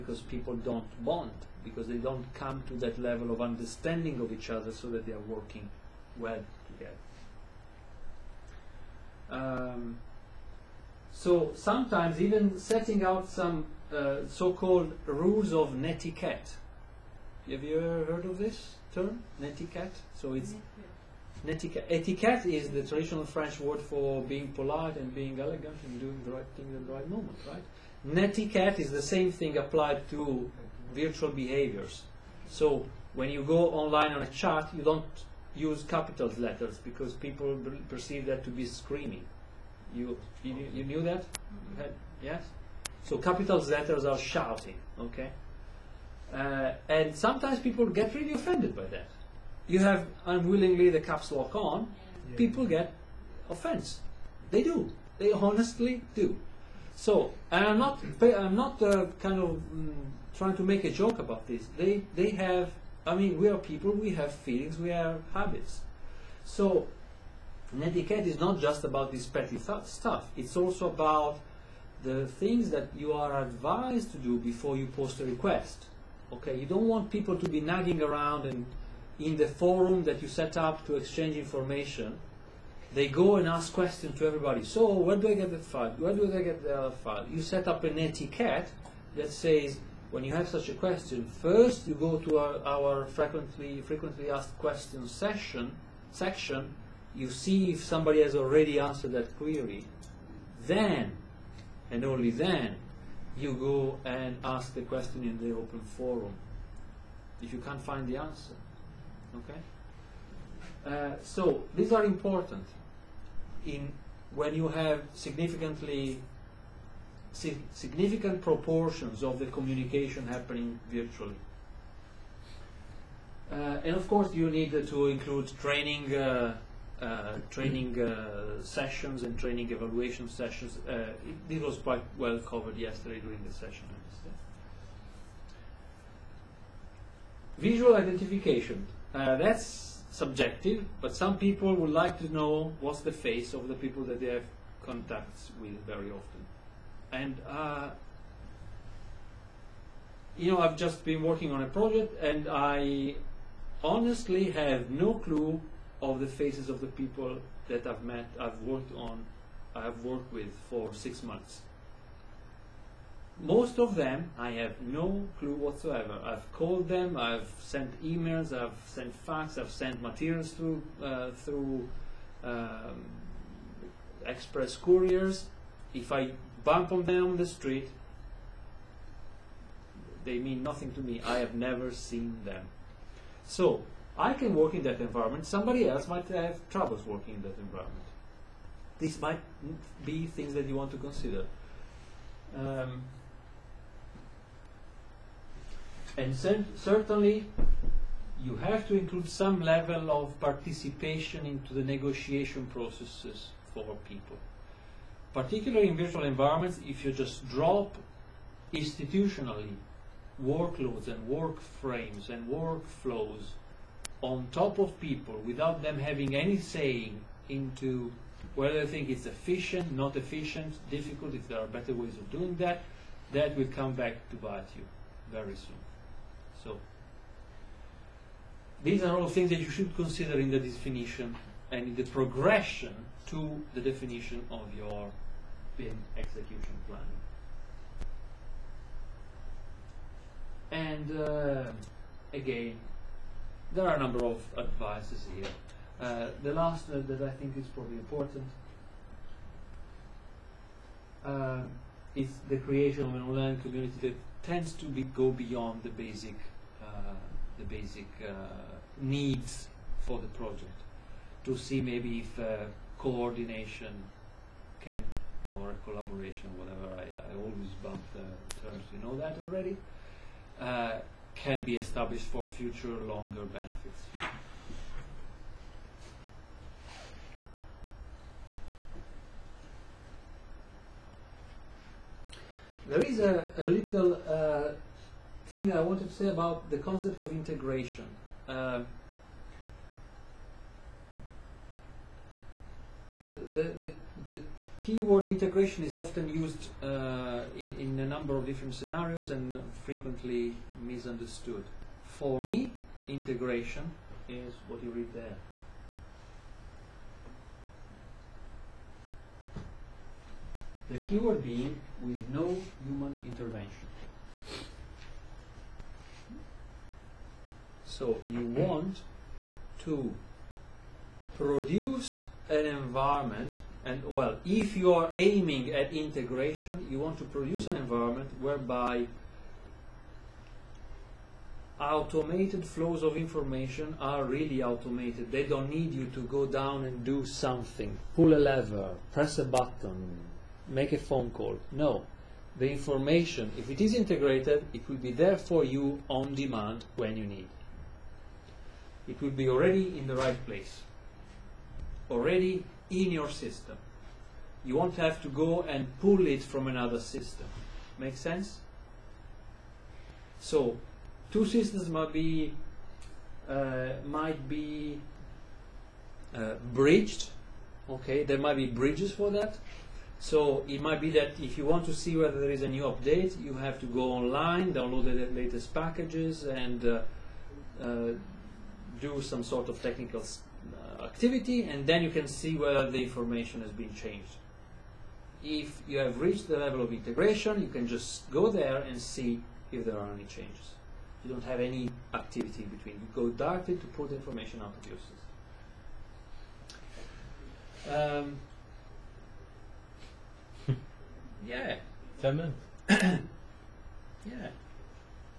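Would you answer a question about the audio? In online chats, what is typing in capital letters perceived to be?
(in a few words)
screaming.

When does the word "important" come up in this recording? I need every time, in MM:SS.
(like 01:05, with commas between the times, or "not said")
01:52, 04:07.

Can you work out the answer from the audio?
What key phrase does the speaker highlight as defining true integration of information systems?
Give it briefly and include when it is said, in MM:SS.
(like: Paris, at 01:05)
with no human intervention, at 05:12.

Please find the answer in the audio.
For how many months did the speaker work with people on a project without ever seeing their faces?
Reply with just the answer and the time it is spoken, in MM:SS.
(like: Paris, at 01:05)
6, at 02:40.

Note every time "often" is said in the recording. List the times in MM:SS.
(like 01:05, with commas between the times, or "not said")
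02:26, 04:55.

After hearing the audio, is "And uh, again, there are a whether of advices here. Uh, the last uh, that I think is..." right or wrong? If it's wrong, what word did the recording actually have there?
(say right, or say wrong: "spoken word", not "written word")
wrong: "number", not "whether".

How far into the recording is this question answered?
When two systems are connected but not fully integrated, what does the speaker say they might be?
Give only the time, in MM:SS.
06:06.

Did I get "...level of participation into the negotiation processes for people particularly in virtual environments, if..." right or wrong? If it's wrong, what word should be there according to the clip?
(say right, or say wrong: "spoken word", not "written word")
right.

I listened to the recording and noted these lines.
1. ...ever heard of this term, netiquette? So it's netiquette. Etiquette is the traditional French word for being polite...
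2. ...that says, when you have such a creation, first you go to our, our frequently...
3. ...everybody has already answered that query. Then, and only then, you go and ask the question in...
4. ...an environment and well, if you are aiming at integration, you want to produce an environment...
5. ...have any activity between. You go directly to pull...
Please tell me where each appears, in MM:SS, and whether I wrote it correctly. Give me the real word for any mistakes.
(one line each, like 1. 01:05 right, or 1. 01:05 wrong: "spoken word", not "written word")
1. 00:17 right
2. 01:29 wrong: "question", not "creation"
3. 01:37 wrong: "somebody", not "everybody"
4. 05:22 right
5. 06:31 right.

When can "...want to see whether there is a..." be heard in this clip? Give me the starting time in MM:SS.
06:11.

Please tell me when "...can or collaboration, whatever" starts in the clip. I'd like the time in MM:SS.
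04:24.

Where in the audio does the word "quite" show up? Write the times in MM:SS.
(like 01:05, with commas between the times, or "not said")
02:11.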